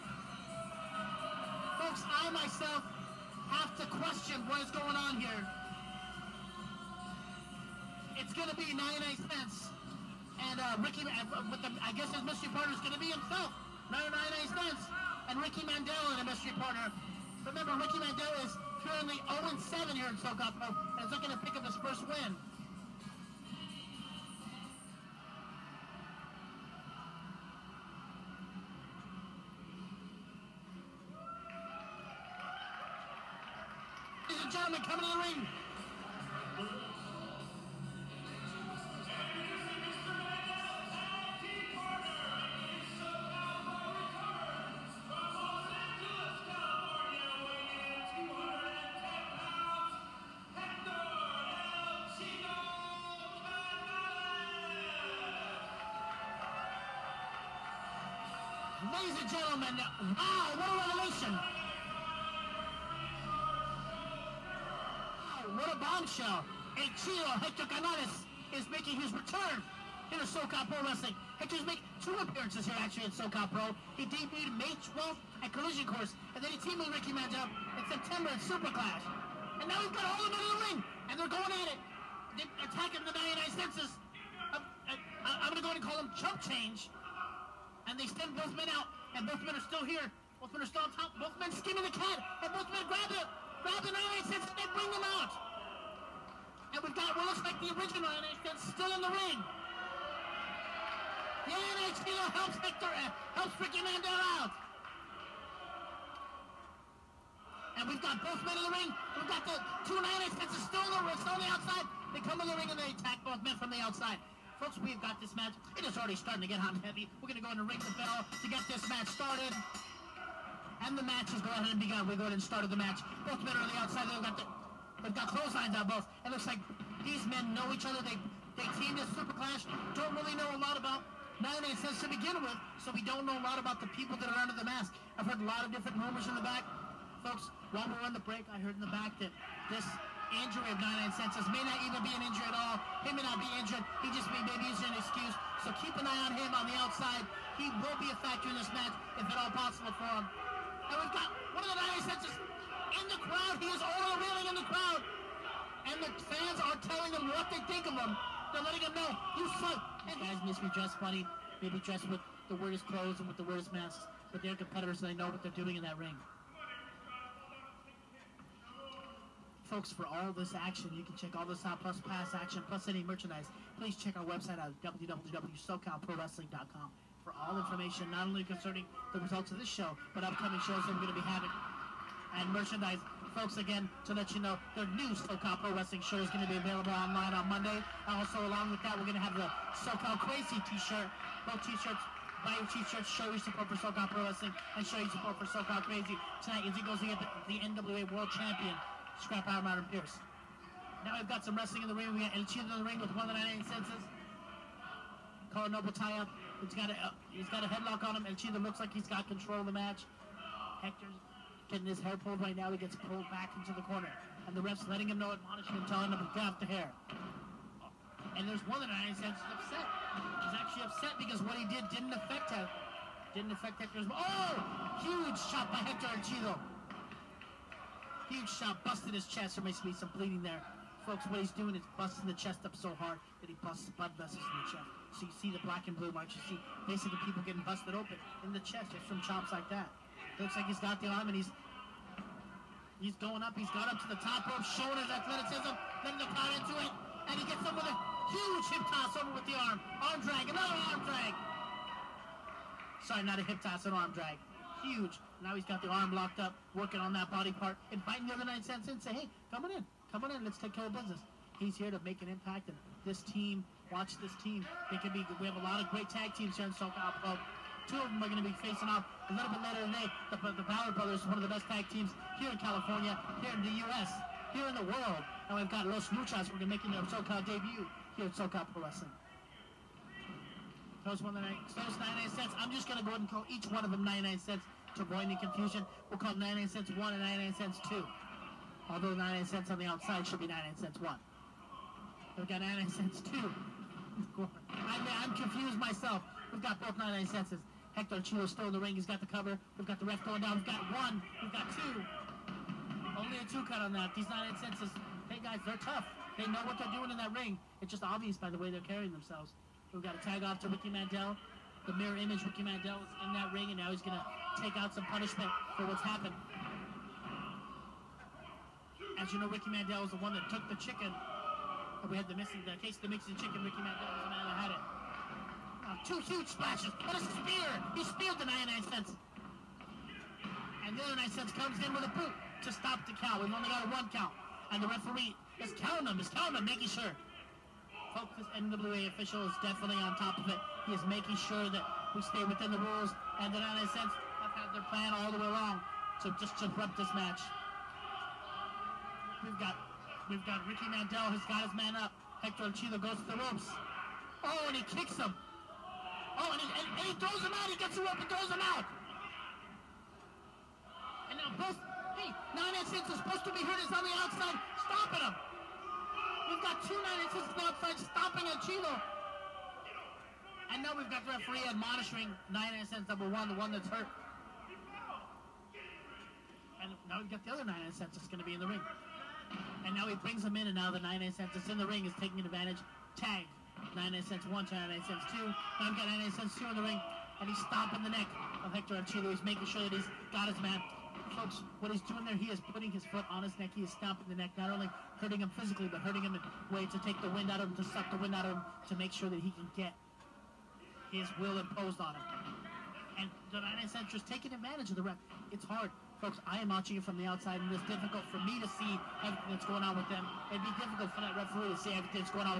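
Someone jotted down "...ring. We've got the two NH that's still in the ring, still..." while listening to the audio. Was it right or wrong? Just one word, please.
right.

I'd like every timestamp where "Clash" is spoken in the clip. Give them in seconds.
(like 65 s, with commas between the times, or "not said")
78 s, 129 s.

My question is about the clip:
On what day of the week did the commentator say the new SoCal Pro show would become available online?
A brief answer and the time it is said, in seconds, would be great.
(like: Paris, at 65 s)
Monday, at 187 s.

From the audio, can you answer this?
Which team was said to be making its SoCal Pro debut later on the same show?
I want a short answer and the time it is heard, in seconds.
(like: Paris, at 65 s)
Los Luchas, at 275 s.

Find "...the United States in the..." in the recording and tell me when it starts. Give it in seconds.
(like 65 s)
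151 s.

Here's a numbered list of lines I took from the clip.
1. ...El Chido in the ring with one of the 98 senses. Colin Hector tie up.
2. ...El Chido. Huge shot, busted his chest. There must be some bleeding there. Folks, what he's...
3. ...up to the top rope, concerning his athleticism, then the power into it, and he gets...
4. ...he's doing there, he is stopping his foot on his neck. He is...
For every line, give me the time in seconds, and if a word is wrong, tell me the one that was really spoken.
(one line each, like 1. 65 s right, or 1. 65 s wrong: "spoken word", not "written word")
1. 202 s wrong: "Noble", not "Hector"
2. 226 s right
3. 243 s wrong: "showing", not "concerning"
4. 391 s wrong: "putting", not "stopping".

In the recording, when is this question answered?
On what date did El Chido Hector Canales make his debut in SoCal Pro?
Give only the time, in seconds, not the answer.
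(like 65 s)
74 s.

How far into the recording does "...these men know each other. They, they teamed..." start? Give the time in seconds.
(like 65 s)
127 s.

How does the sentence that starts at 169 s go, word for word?
folks, for all this action, you can check all this out, plus pass action, plus any merchandise.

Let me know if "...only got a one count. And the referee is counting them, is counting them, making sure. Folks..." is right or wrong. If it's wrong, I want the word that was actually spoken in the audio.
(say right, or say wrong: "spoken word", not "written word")
right.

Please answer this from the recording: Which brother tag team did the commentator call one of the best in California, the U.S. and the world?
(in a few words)
The Ballard Brothers.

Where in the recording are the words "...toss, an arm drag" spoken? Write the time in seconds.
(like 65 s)
253 s.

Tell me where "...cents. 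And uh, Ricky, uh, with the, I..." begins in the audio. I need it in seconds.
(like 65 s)
9 s.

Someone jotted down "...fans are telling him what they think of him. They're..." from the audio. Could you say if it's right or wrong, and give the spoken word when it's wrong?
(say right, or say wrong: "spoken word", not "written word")
right.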